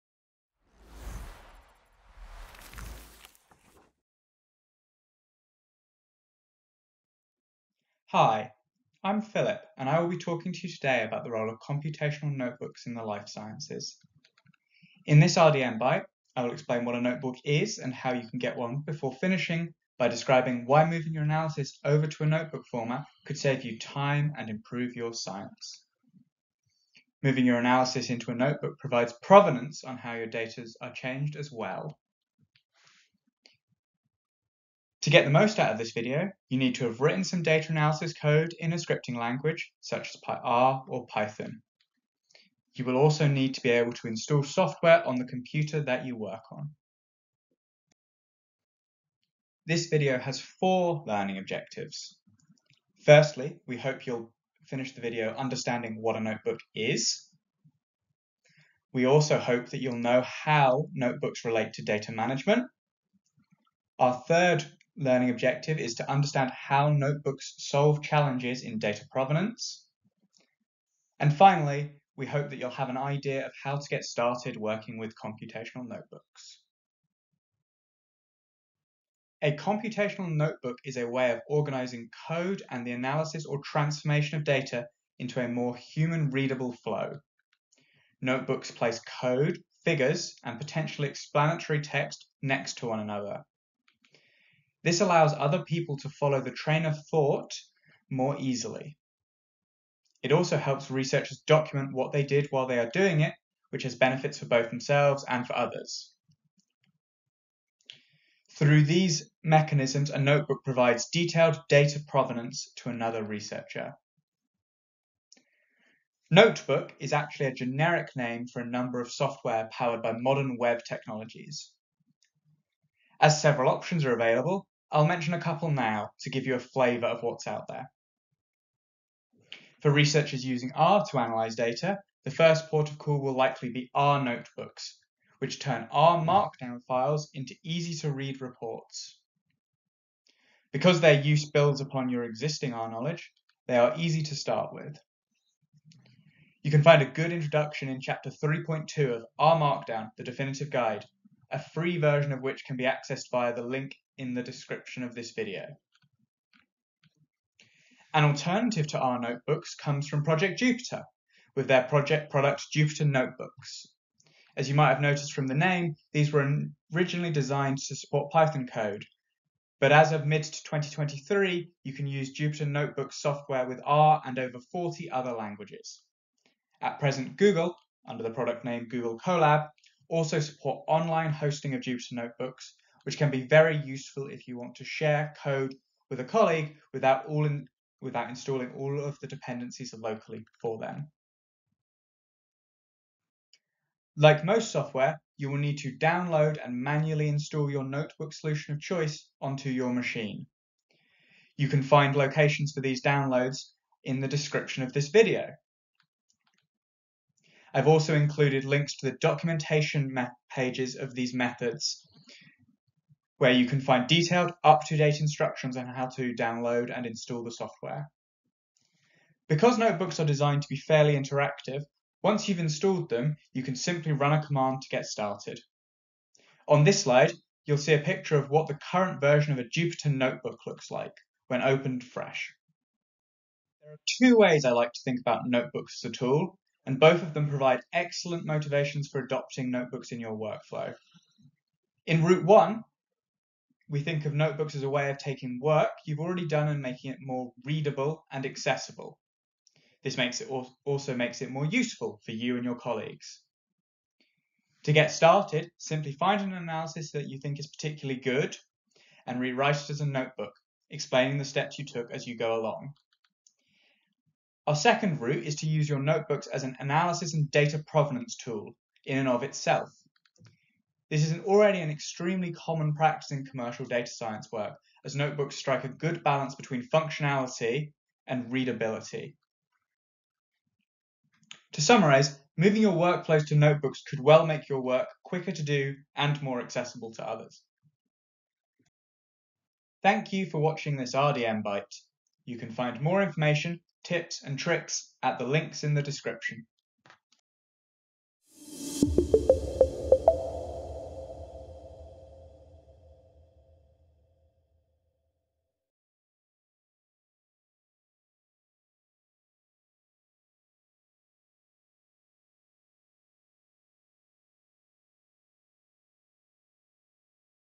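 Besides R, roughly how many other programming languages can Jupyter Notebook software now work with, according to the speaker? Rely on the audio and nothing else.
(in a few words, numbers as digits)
over 40.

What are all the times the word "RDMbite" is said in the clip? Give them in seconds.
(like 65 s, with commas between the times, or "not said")
15 s, 291 s.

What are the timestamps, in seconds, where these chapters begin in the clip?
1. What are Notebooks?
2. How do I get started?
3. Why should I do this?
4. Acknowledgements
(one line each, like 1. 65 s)
1. 78 s
2. 193 s
3. 234 s
4. 289 s.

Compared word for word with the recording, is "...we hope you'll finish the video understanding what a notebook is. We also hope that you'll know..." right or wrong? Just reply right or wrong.
right.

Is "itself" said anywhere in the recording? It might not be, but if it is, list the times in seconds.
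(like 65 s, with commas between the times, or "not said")
269 s.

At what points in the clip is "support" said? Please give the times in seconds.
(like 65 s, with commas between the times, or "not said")
167 s, 180 s.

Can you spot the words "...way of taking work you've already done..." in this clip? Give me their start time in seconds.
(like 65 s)
244 s.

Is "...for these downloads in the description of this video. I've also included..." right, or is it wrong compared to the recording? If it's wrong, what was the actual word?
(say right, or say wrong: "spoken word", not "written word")
right.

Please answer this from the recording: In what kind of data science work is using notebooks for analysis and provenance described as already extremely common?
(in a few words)
commercial.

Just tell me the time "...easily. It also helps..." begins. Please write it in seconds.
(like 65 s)
98 s.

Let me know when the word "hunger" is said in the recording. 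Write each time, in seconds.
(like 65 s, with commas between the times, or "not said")
not said.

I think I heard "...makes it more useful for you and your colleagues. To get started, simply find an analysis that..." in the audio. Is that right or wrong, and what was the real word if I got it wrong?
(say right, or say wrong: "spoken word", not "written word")
right.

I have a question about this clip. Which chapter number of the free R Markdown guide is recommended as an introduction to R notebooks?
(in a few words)
3.2.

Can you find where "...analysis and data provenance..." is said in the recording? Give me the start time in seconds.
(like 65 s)
266 s.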